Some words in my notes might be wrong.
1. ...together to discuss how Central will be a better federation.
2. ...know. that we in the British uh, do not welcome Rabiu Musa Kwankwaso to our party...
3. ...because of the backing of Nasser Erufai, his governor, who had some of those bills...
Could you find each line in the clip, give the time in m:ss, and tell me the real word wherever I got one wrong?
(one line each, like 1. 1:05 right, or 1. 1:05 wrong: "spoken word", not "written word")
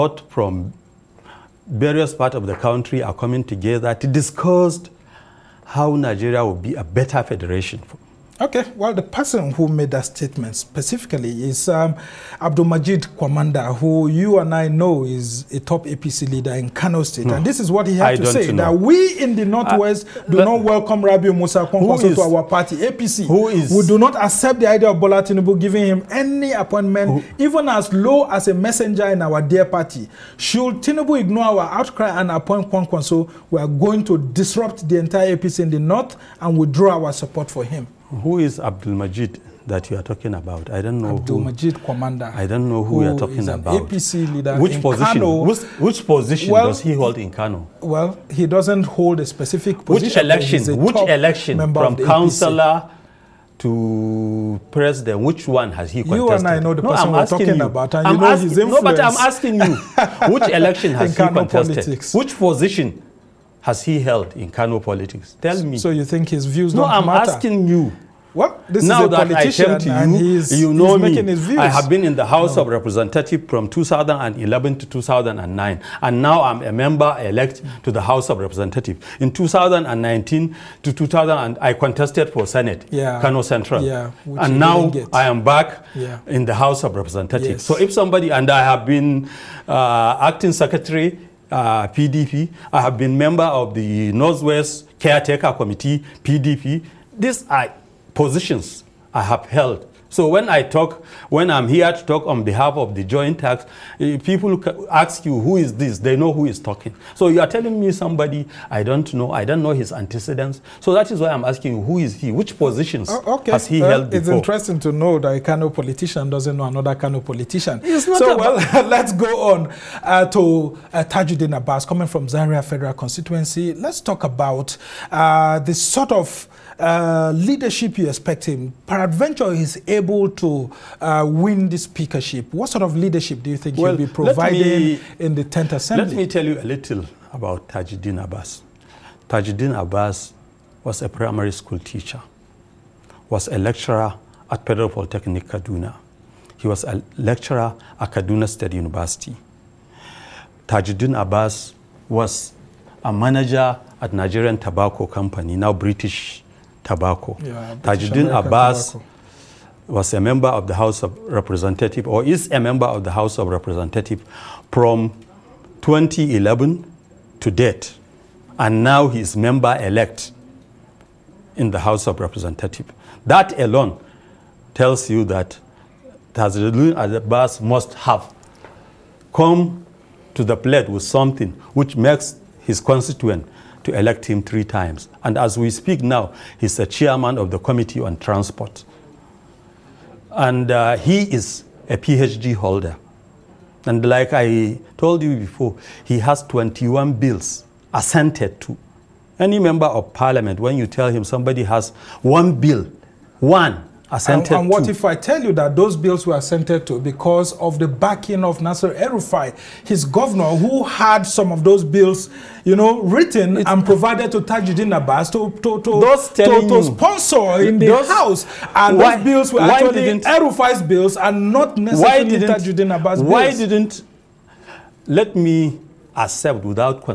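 1. 0:03 wrong: "Nigeria", not "Central"
2. 0:18 wrong: "Northwest", not "British"
3. 3:26 right.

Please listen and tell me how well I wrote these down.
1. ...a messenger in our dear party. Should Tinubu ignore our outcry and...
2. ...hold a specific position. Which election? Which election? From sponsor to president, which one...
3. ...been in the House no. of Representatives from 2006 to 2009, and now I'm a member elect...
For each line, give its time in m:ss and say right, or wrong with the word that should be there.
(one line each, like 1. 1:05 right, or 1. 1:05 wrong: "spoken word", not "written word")
1. 0:28 right
2. 0:48 wrong: "councillor", not "sponsor"
3. 1:11 wrong: "2011", not "2006".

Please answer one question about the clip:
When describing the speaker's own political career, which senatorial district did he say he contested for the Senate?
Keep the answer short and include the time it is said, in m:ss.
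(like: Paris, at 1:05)
Kano Central, at 1:23.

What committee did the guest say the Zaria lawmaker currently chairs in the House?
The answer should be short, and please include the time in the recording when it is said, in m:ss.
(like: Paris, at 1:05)
Committee on Transport, at 3:07.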